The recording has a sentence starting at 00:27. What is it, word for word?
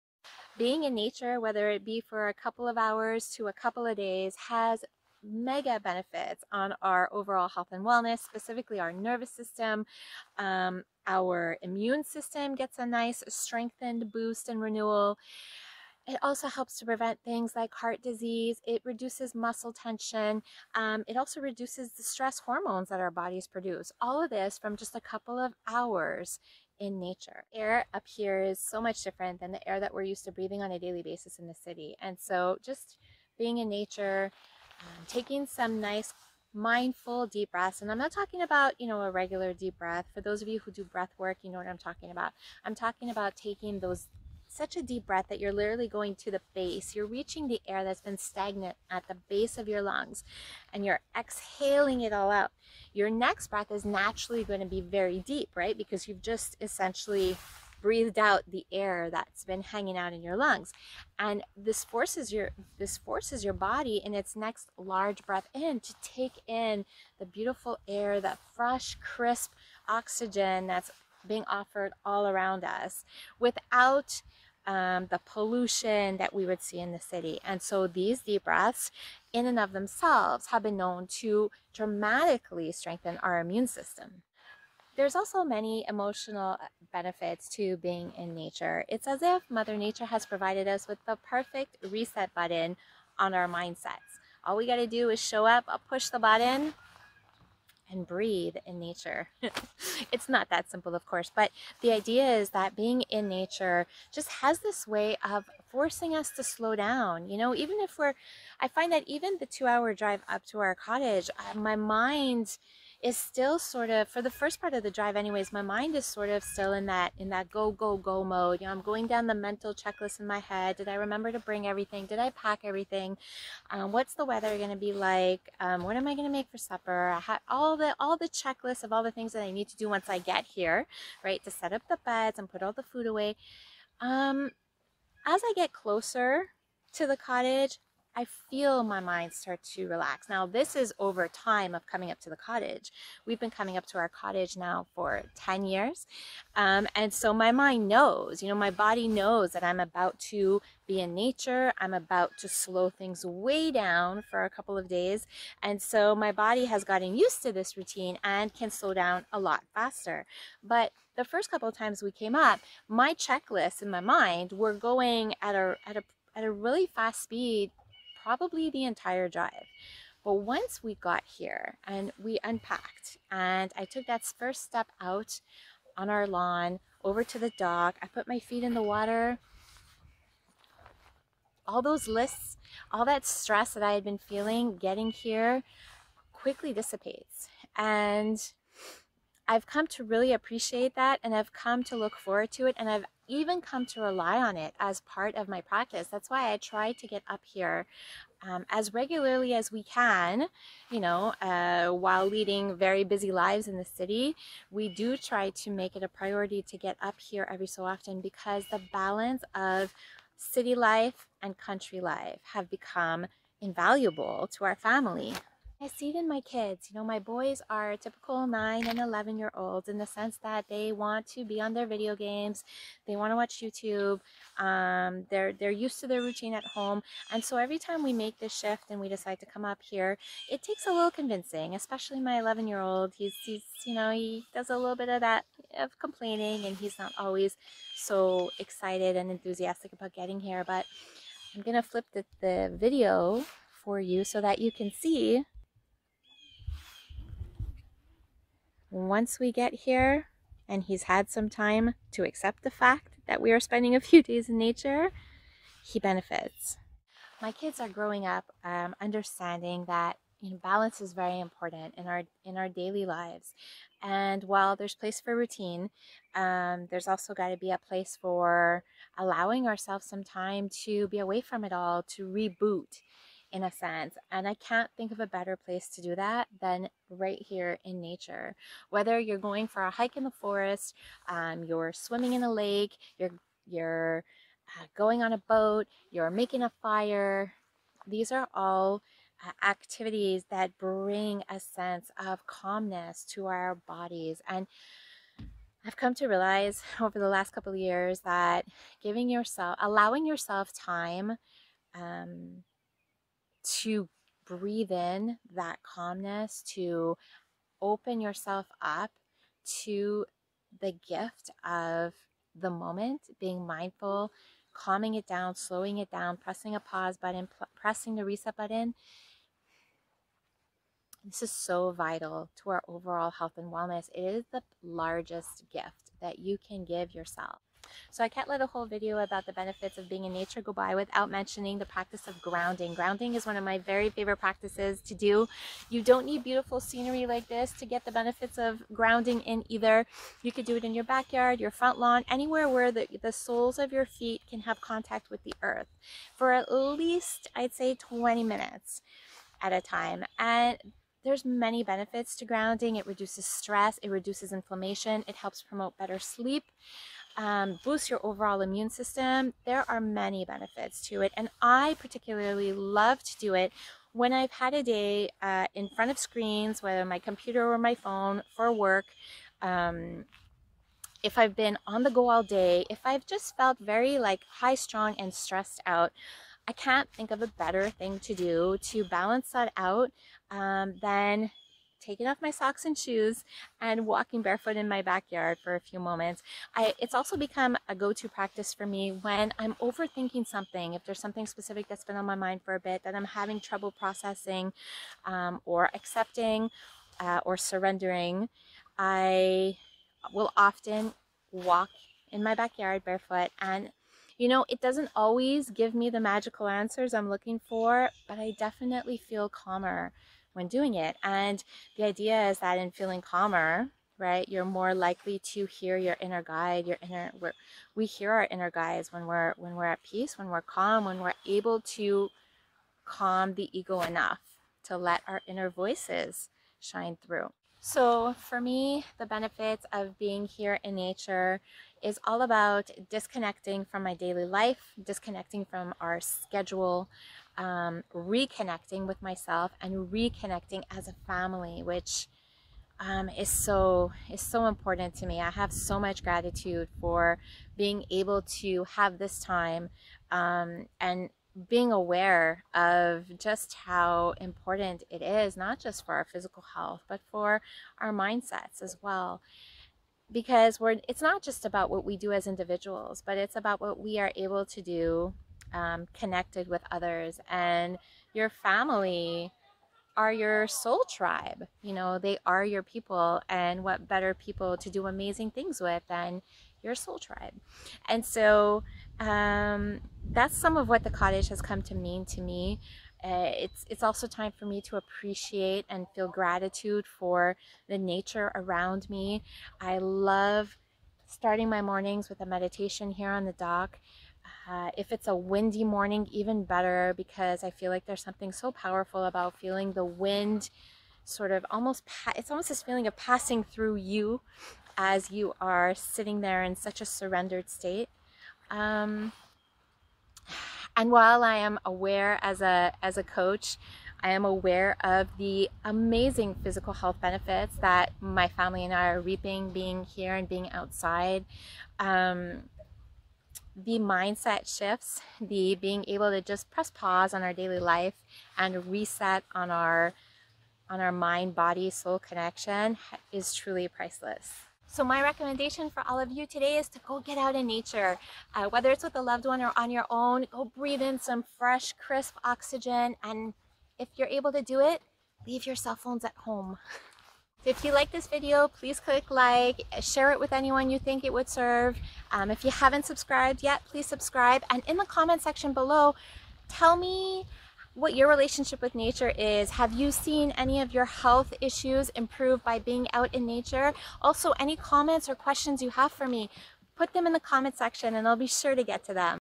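Air up here is so much different than the air that we're used to breathing on a daily basis in the city.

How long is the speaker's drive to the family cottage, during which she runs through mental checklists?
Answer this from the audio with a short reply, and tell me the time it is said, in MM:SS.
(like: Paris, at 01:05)
2 hours, at 01:49.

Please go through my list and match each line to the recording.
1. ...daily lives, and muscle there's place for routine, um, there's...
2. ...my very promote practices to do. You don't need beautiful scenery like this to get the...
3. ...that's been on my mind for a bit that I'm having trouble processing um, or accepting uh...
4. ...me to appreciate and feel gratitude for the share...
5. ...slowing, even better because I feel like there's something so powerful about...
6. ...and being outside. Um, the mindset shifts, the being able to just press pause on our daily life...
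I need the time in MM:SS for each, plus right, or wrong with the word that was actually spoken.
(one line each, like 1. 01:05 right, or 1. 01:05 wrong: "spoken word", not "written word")
1. 04:22 wrong: "while", not "muscle"
2. 05:33 wrong: "favorite", not "promote"
3. 06:31 right
4. 08:04 wrong: "nature", not "share"
5. 08:15 wrong: "morning", not "slowing"
6. 08:40 right.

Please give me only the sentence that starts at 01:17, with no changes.
And so these deep breaths, in and of themselves, have been known to dramatically strengthen our immune system.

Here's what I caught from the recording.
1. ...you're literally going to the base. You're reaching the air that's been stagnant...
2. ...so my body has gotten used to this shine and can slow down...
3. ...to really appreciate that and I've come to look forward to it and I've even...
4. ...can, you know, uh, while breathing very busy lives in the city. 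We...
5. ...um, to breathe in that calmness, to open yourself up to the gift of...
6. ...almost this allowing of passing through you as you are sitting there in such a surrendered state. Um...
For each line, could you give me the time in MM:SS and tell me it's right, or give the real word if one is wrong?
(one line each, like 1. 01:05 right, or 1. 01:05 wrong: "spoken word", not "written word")
1. 00:45 right
2. 02:35 wrong: "routine", not "shine"
3. 03:09 right
4. 03:19 wrong: "leading", not "breathing"
5. 05:01 right
6. 08:22 wrong: "feeling", not "allowing".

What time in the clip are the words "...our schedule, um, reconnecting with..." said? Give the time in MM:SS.
07:15.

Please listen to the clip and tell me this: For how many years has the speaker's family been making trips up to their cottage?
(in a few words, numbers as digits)
10 years.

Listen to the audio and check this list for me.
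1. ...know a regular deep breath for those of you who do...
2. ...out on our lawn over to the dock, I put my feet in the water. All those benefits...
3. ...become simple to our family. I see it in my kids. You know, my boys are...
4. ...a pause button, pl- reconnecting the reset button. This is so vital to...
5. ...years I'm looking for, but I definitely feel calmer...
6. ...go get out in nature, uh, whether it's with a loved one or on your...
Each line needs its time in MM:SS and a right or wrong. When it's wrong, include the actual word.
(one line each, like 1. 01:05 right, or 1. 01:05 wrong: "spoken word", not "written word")
1. 00:38 right
2. 02:54 wrong: "lists", not "benefits"
3. 03:32 wrong: "invaluable", not "simple"
4. 05:16 wrong: "pressing", not "reconnecting"
5. 06:46 wrong: "answers", not "years"
6. 08:57 right.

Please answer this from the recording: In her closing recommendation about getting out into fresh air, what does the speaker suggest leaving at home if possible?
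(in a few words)
Cell phones.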